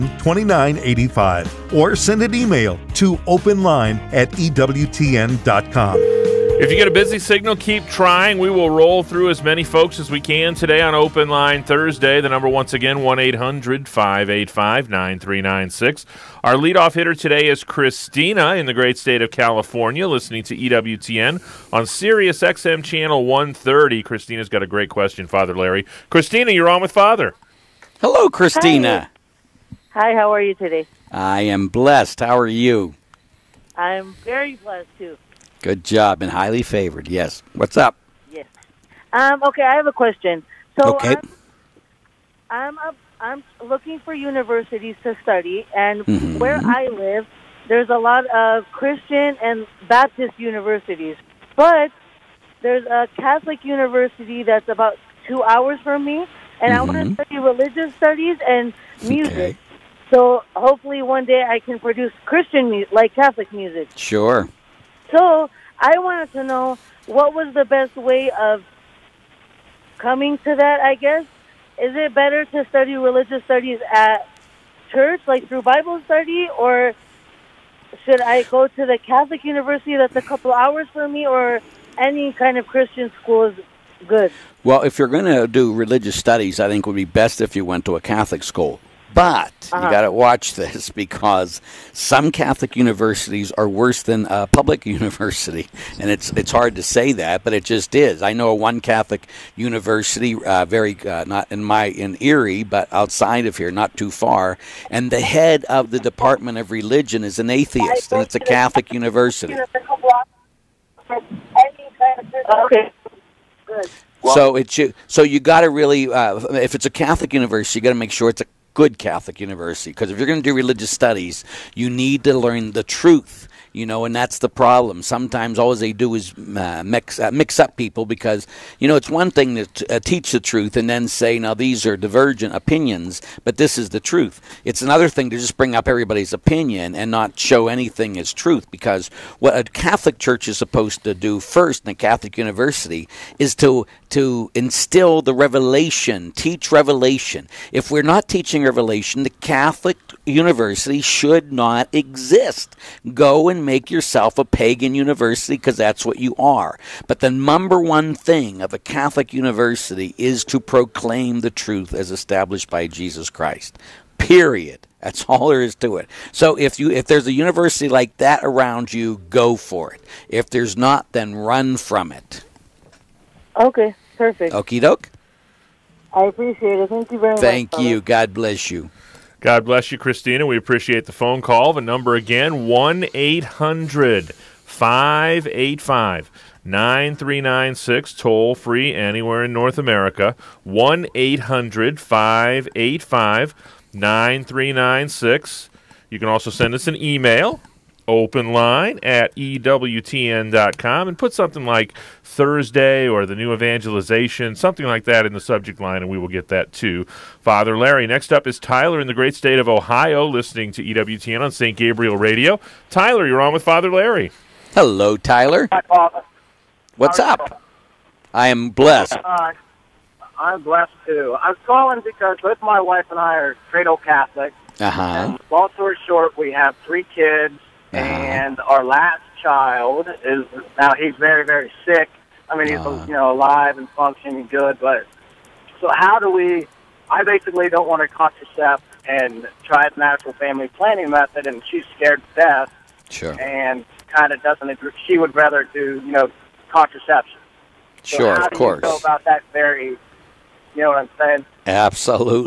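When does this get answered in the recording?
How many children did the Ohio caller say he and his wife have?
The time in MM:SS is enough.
03:46.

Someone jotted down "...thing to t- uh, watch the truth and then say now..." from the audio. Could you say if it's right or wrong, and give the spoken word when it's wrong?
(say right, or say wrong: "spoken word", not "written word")
wrong: "teach", not "watch".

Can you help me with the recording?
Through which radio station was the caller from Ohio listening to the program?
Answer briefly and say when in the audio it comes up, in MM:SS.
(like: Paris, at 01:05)
St. Gabriel Radio, at 03:31.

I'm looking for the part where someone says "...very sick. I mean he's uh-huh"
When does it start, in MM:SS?
03:51.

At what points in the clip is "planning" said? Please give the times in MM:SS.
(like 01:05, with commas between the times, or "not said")
04:00.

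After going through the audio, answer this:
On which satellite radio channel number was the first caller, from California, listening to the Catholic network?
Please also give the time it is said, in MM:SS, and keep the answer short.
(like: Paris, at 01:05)
130, at 00:22.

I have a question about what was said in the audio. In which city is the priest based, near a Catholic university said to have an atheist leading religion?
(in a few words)
Erie.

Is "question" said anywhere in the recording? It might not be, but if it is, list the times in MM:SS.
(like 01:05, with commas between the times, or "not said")
00:24, 00:39.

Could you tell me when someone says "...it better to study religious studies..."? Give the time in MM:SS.
01:11.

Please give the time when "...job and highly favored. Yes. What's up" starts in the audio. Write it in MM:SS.
00:35.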